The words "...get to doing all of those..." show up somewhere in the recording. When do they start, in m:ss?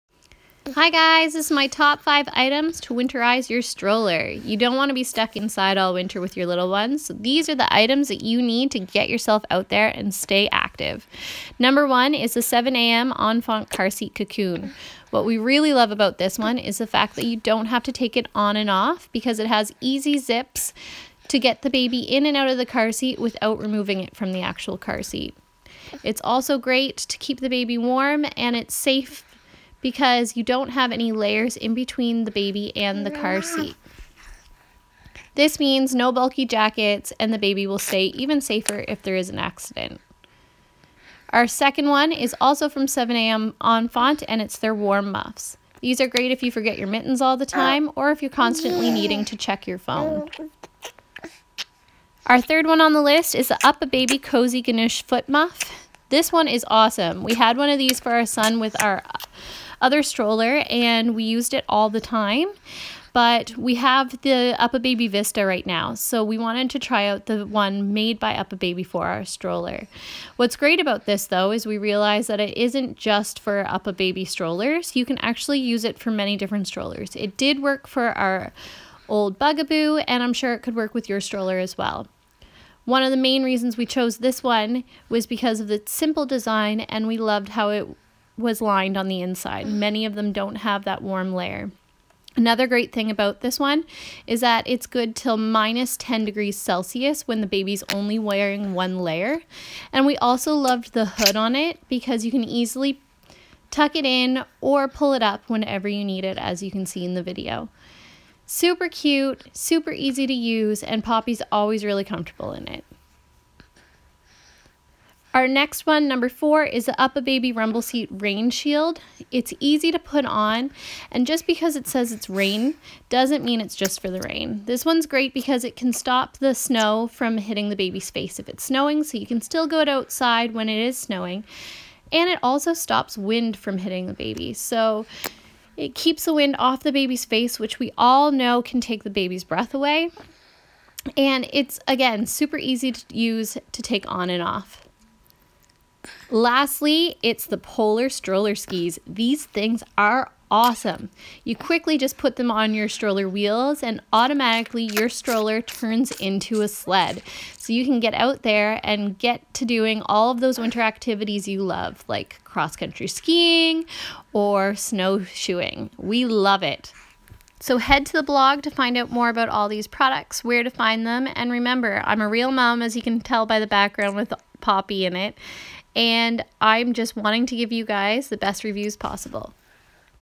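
2:39.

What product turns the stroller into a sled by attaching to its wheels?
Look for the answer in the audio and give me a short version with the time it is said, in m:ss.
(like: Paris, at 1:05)
Polar Stroller Skis, at 2:27.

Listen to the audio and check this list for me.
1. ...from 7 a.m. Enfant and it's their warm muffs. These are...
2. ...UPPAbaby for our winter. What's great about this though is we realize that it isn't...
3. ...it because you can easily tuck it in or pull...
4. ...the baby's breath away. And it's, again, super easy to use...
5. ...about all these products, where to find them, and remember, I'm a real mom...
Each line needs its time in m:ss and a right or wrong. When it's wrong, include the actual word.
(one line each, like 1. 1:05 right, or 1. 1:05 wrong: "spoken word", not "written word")
1. 0:42 right
2. 1:08 wrong: "stroller", not "winter"
3. 1:41 right
4. 2:19 right
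5. 2:49 right.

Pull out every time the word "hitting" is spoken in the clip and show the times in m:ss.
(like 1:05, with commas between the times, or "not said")
2:07, 2:13.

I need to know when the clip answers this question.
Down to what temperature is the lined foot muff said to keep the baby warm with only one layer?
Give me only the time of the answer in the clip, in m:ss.
1:35.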